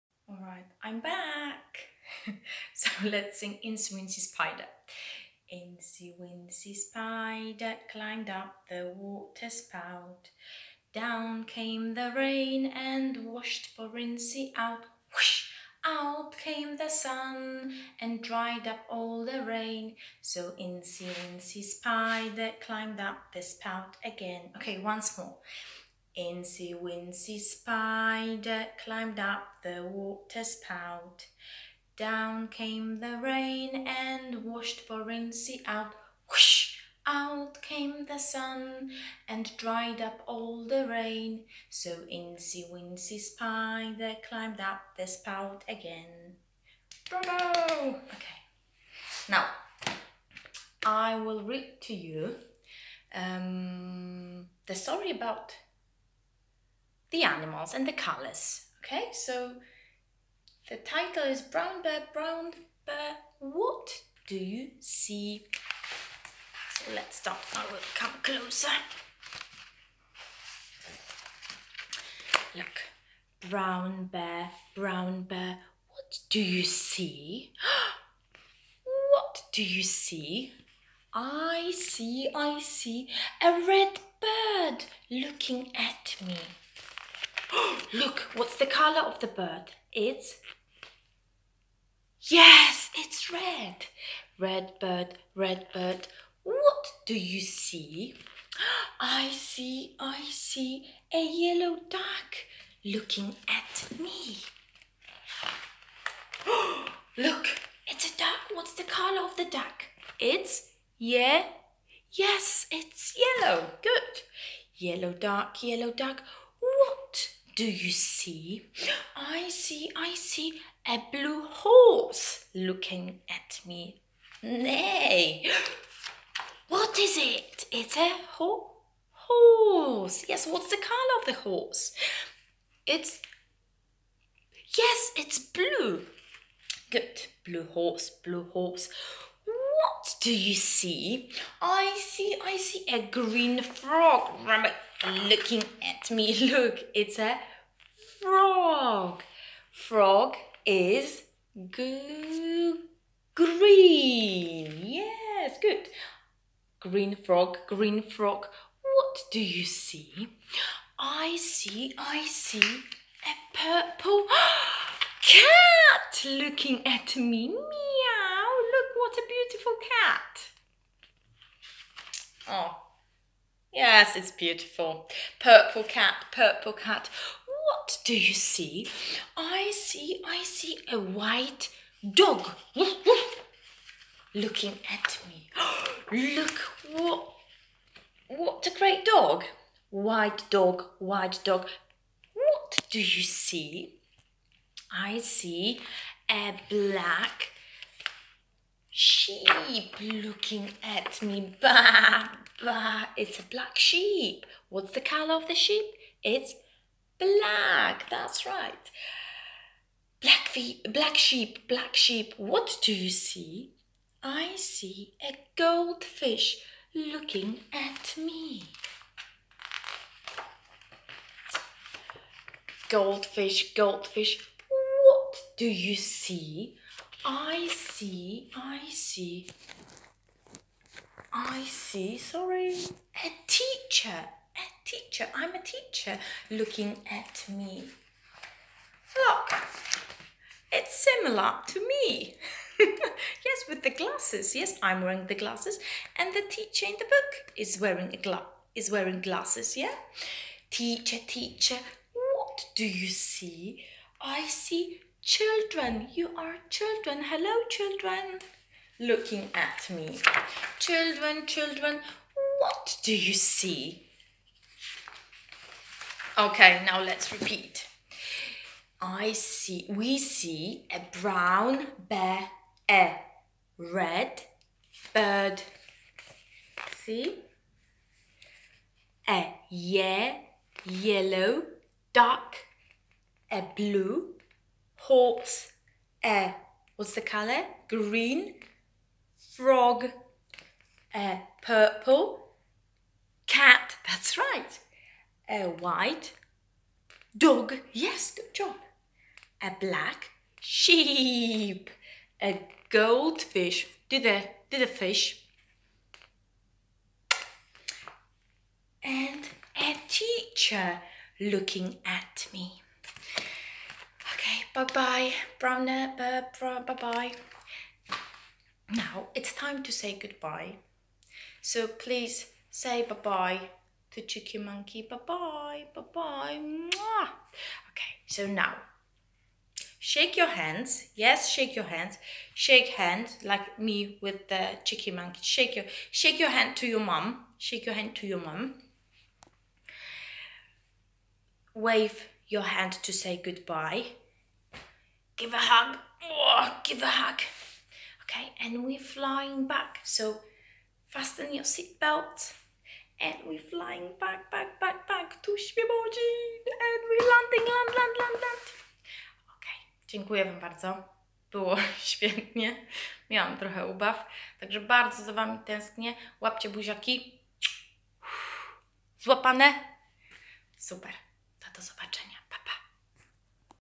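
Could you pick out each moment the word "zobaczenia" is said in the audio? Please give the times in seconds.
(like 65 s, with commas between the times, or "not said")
371 s.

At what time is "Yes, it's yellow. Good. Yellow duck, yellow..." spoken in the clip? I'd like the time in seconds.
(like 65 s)
112 s.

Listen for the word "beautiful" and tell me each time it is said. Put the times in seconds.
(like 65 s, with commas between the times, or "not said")
169 s, 174 s.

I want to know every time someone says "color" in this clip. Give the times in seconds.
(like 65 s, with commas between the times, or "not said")
57 s, 88 s, 108 s, 130 s, 205 s, 287 s.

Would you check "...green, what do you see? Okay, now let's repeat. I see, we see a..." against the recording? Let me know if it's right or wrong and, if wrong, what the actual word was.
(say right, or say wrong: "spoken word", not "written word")
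wrong: "children", not "green".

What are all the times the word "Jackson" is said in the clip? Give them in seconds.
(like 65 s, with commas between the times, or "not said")
not said.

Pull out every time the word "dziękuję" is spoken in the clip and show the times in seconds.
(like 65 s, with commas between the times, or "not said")
360 s.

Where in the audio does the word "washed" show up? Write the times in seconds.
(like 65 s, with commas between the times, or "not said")
13 s, 34 s.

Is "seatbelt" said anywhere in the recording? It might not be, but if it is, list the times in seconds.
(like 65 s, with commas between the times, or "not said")
351 s.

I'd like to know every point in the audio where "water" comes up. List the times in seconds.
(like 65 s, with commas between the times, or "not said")
8 s, 29 s.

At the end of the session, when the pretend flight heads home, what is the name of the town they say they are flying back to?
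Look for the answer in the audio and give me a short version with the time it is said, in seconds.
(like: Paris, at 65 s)
Świebodzin, at 355 s.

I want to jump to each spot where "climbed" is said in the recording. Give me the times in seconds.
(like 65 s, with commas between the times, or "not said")
7 s, 22 s, 28 s, 44 s.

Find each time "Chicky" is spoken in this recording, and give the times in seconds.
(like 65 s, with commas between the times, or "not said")
324 s, 334 s.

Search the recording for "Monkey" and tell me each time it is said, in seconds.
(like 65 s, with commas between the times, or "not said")
324 s, 335 s.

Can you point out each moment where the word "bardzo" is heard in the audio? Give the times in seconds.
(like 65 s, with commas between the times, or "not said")
360 s, 364 s.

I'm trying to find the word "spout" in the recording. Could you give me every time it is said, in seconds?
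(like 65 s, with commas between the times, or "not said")
9 s, 23 s, 30 s, 45 s.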